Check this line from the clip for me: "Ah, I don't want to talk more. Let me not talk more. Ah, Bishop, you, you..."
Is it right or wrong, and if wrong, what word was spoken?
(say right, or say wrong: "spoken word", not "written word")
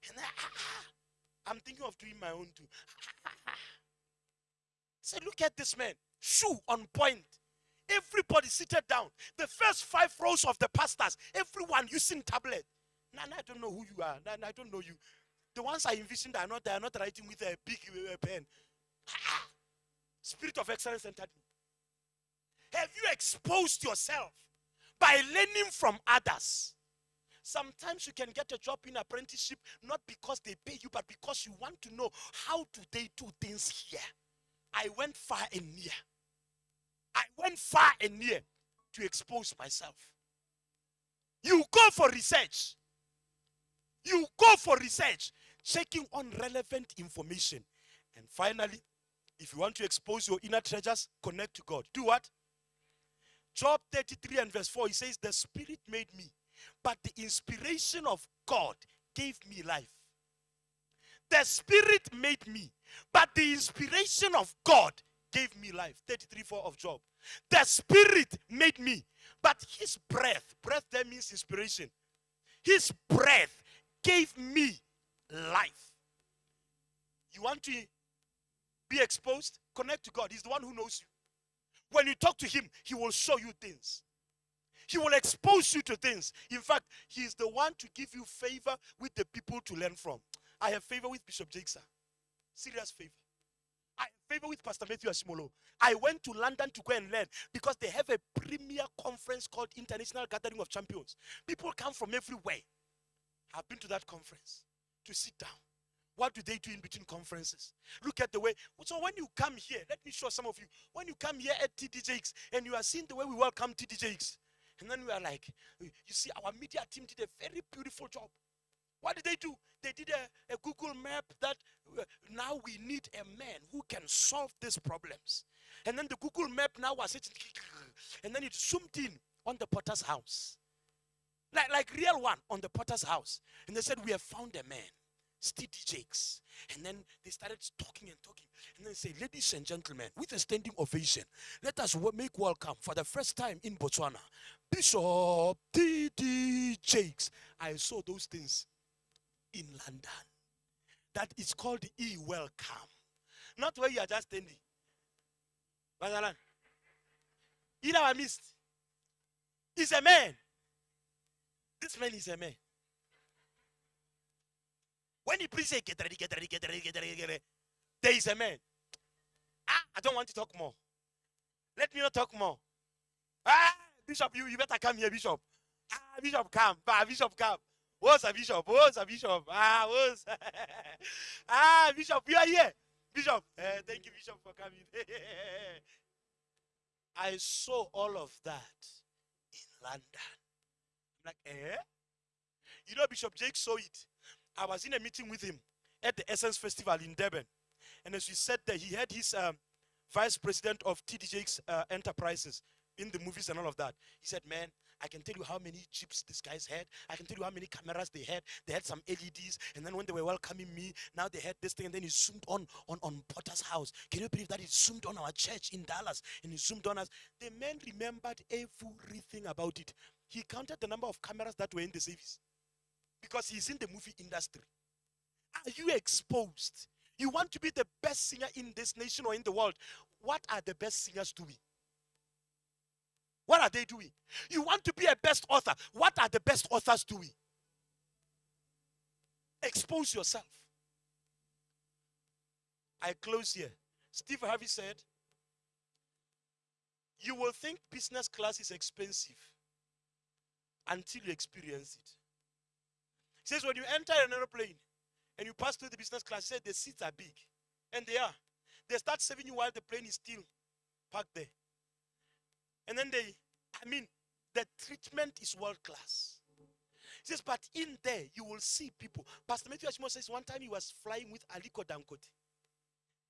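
right.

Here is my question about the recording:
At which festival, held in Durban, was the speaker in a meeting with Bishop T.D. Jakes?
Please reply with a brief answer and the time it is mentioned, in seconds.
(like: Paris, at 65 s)
Essence Festival, at 196 s.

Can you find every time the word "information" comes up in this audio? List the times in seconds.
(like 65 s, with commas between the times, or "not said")
46 s.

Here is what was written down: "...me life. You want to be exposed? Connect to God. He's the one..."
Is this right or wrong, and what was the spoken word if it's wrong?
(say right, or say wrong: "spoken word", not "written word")
right.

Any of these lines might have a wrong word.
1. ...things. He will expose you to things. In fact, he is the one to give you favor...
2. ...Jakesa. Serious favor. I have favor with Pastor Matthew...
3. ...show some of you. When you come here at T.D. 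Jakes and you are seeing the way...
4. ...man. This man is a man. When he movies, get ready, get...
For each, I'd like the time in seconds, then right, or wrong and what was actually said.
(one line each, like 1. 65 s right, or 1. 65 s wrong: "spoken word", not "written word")
1. 83 s right
2. 91 s right
3. 110 s right
4. 160 s wrong: "preaches", not "movies".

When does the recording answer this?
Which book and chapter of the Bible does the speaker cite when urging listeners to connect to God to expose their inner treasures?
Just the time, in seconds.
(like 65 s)
53 s.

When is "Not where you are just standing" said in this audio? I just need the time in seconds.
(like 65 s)
153 s.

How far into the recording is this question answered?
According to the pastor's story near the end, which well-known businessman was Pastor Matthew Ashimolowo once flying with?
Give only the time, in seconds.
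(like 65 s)
271 s.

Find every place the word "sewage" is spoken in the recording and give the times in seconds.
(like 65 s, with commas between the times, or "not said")
not said.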